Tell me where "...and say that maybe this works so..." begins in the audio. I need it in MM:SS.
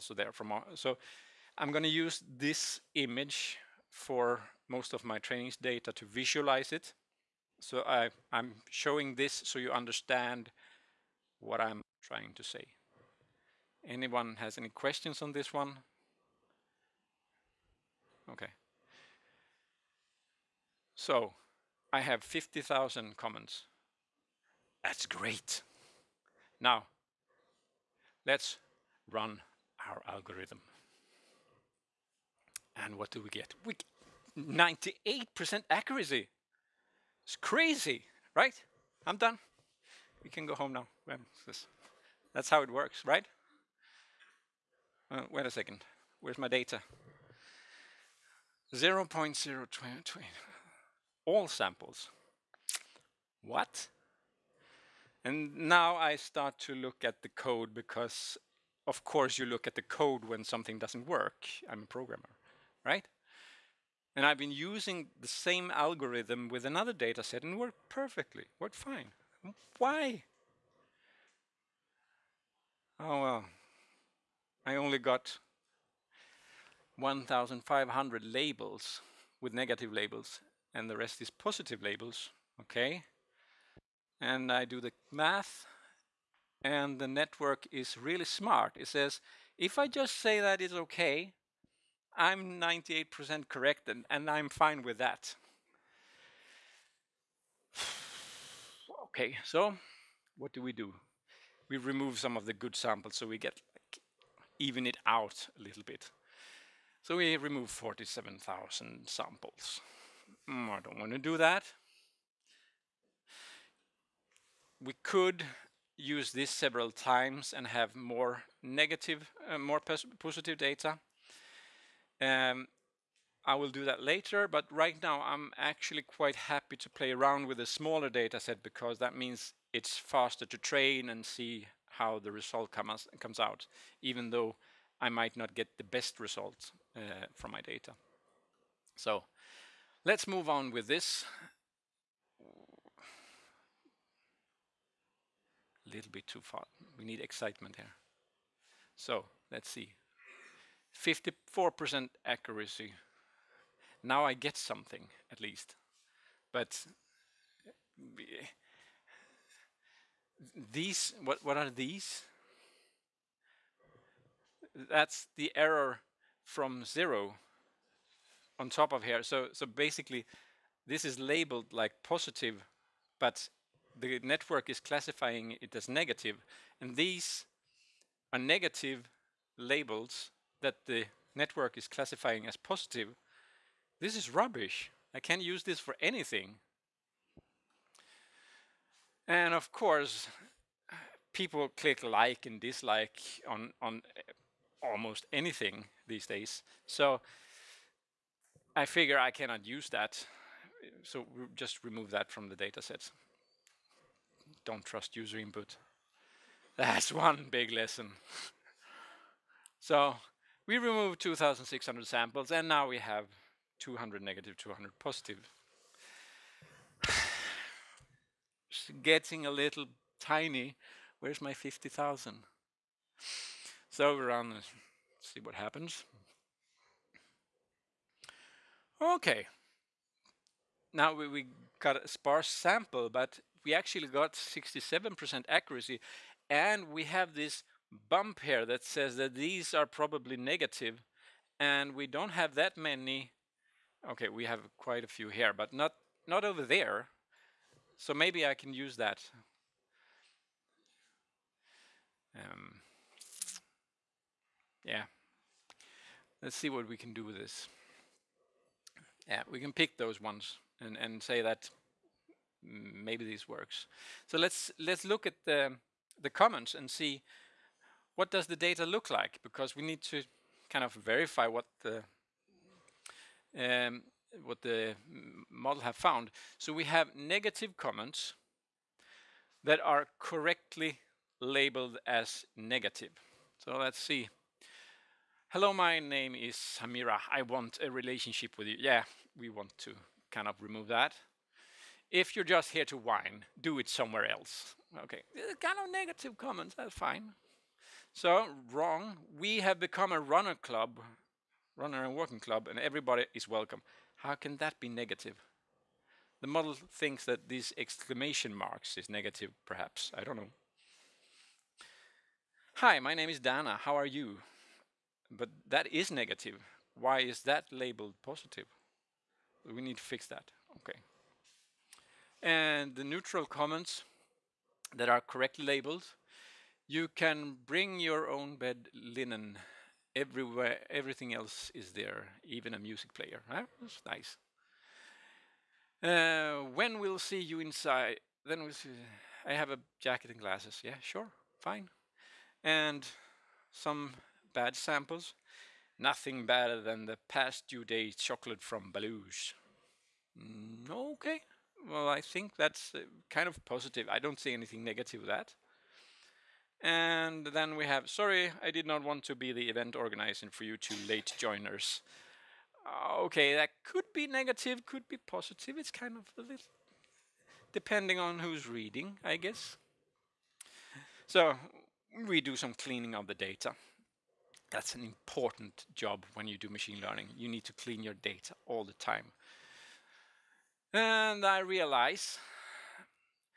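04:20.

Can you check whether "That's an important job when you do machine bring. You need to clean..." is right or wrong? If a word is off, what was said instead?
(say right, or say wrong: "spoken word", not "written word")
wrong: "learning", not "bring".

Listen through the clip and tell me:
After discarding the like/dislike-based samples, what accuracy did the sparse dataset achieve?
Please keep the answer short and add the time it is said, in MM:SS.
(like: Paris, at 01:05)
67%, at 03:54.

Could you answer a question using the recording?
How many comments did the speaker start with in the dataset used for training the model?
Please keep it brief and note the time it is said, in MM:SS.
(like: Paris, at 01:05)
50,000, at 00:22.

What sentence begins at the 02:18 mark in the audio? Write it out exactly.
So let's move on with this.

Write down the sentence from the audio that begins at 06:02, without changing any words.
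Uh, okay, that could be negative, could be positive.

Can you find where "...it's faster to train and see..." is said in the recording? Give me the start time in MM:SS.
02:09.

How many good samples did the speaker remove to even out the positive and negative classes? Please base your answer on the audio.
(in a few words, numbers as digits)
47,000.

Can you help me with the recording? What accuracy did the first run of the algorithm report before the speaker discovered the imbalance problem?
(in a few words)
98%.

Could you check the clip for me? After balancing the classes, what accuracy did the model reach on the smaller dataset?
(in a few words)
54%.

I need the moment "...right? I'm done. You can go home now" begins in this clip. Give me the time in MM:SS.
00:38.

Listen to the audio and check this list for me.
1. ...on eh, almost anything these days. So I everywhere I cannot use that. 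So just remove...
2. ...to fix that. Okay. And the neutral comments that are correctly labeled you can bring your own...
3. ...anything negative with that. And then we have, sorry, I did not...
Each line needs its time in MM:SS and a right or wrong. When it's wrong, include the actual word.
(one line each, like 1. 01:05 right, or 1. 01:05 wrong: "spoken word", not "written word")
1. 03:13 wrong: "figure", not "everywhere"
2. 05:19 right
3. 05:54 right.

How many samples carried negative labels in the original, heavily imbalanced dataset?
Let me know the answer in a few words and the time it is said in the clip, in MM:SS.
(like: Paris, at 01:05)
1,500, at 01:16.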